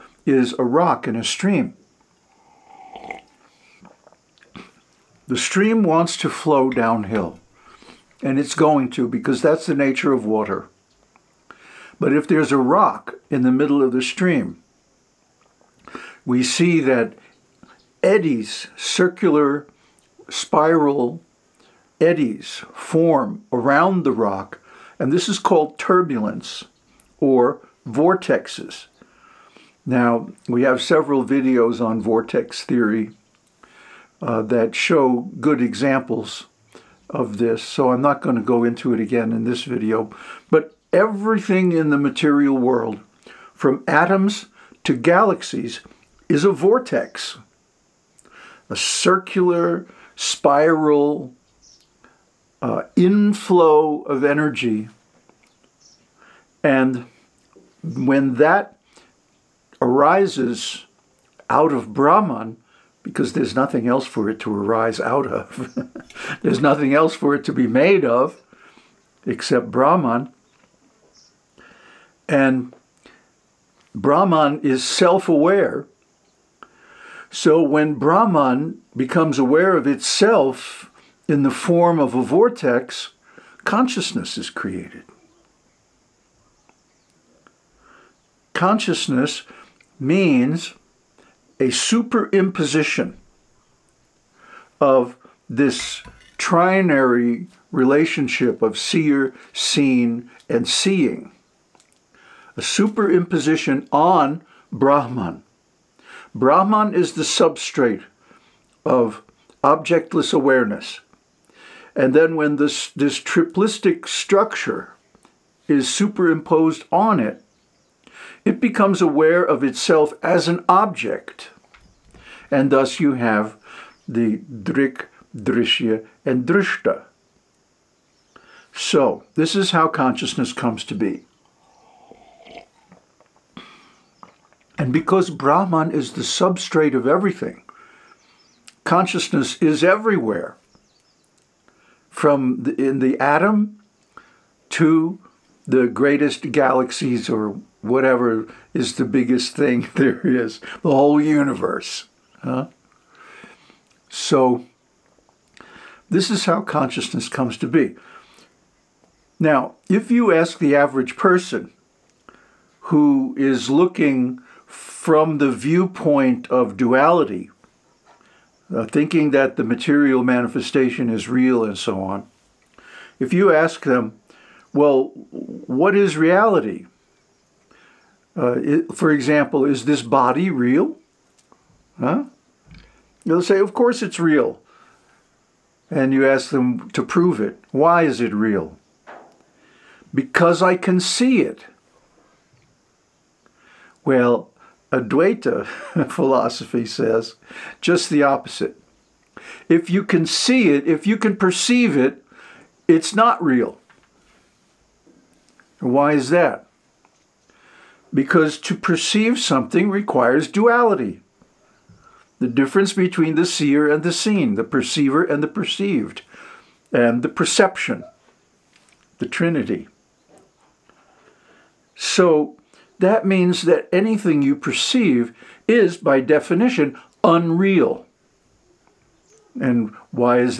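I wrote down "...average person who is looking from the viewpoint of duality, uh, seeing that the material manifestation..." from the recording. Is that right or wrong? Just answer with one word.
wrong.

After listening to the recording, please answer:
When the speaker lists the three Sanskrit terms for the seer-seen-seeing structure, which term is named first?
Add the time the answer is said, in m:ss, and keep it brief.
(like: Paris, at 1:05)
Drik, at 2:04.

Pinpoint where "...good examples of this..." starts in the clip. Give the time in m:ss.
0:35.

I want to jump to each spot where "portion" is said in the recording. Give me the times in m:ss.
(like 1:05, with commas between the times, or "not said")
not said.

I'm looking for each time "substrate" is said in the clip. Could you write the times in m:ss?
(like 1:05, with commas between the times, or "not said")
1:47, 2:16.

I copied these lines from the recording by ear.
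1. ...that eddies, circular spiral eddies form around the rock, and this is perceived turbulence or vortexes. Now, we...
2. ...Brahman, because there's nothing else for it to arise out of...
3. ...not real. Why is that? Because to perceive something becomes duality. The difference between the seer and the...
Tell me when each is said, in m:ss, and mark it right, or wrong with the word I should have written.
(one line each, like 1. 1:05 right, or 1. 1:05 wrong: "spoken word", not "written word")
1. 0:16 wrong: "called", not "perceived"
2. 1:01 right
3. 3:23 wrong: "requires", not "becomes".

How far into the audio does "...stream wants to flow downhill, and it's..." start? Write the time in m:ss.
0:05.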